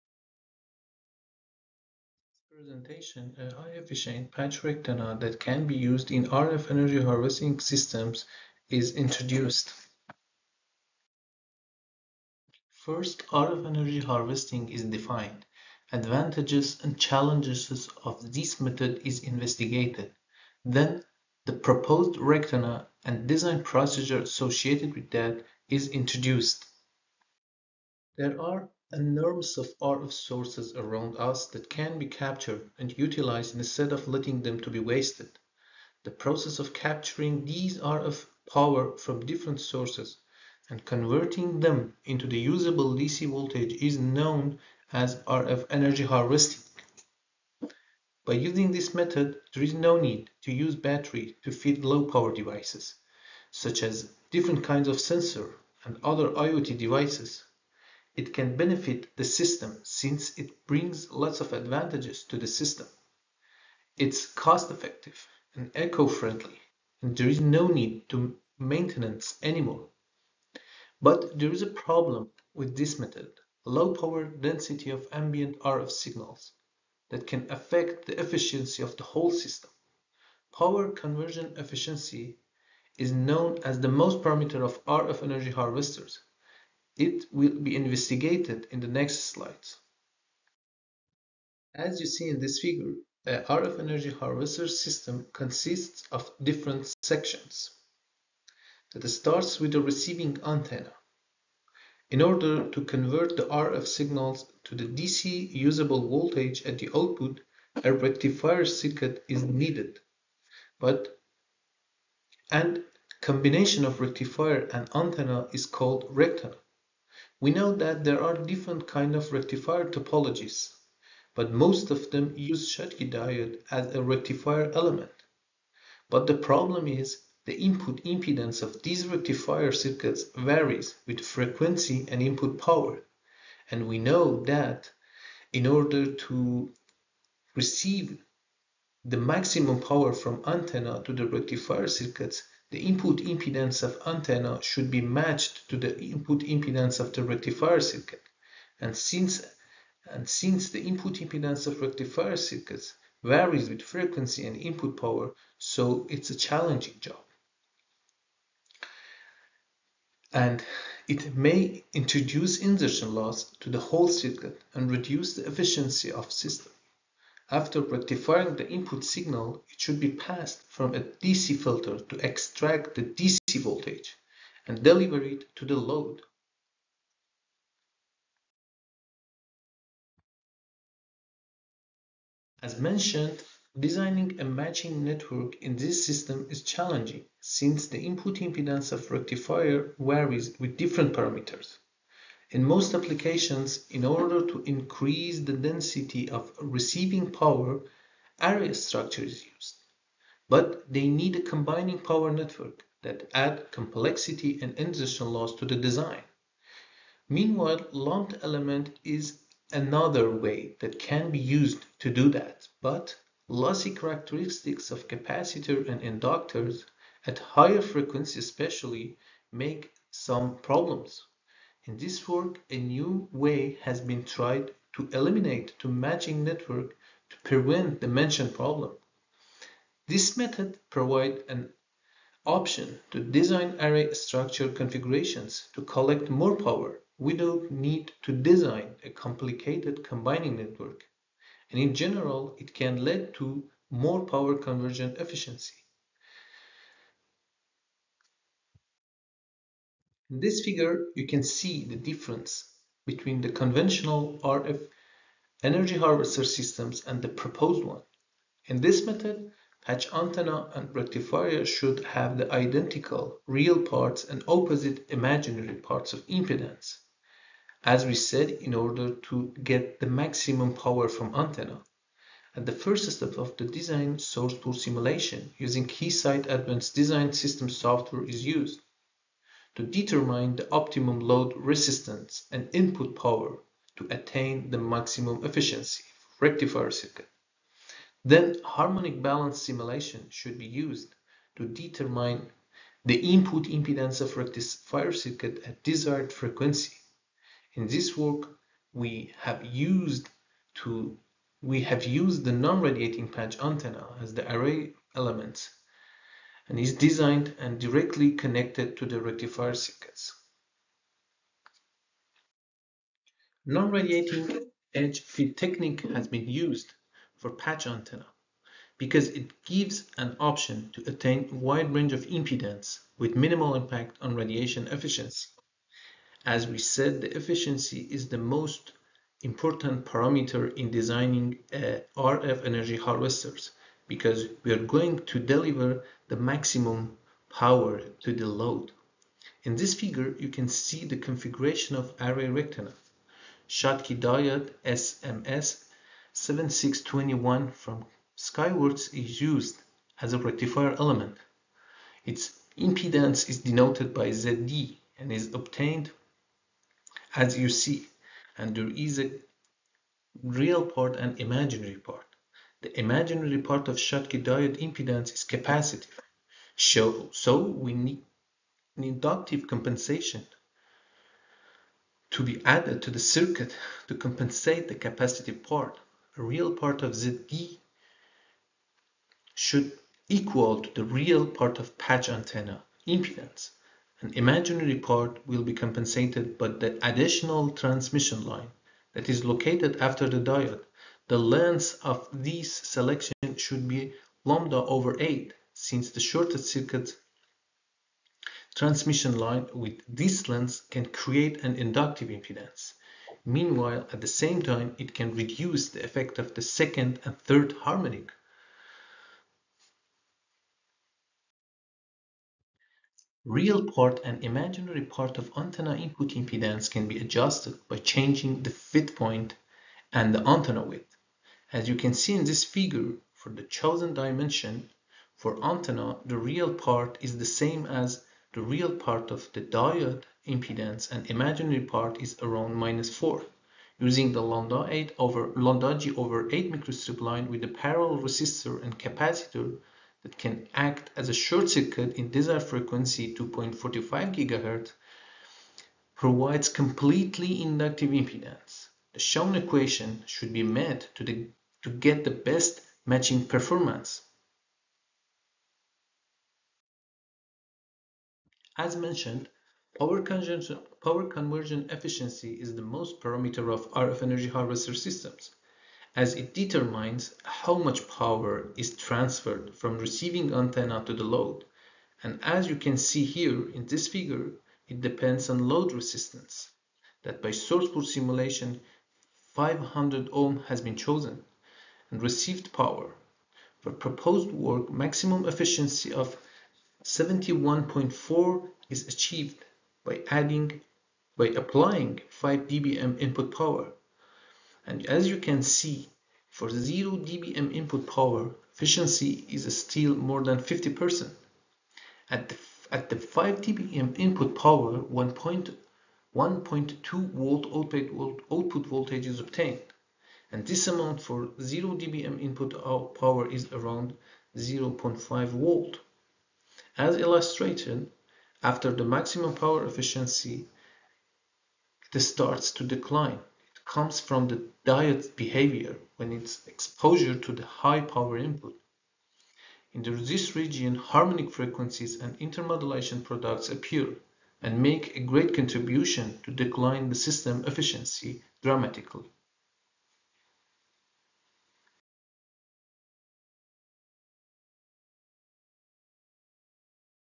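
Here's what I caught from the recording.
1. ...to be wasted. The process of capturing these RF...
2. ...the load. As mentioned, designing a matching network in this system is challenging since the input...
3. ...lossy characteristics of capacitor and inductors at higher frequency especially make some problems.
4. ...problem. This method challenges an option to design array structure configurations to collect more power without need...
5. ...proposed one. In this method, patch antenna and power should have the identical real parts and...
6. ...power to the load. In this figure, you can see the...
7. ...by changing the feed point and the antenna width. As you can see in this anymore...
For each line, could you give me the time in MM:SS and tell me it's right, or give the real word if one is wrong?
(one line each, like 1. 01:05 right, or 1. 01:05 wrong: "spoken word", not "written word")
1. 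00:34 right
2. 02:55 right
3. 03:33 right
4. 03:48 wrong: "provides", not "challenges"
5. 04:17 wrong: "rectifier", not "power"
6. 05:37 right
7. 06:57 wrong: "figure", not "anymore".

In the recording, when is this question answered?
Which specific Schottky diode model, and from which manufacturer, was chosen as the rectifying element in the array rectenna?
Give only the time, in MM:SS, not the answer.
05:45.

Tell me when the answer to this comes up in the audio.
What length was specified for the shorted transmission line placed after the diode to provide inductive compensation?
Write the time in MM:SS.
06:34.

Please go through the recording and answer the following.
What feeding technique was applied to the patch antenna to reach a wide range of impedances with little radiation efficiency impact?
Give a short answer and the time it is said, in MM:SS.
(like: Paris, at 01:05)
Non-radiating edge feed, at 05:13.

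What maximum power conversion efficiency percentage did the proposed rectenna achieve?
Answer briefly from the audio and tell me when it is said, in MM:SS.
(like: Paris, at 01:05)
71.4%, at 08:07.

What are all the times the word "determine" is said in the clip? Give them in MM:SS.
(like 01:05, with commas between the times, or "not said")
04:39, 04:51, 07:46.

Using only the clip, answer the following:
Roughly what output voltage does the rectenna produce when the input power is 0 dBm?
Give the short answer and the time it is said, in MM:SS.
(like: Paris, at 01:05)
0.5 volt, at 08:33.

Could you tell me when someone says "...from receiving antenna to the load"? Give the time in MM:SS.
07:49.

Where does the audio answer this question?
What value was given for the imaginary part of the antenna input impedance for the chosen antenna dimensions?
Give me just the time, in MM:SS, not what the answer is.
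07:12.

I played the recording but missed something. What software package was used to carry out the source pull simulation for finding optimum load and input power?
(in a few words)
Keysight Advanced Design System.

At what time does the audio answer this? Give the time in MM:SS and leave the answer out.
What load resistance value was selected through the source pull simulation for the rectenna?
07:59.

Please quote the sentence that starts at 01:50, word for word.
But and combination of rectifier and antenna is called rectenna.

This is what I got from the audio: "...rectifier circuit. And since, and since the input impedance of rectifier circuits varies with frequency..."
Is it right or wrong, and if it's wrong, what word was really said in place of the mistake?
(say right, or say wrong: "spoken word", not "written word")
right.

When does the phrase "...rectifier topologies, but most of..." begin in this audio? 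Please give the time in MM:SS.
01:59.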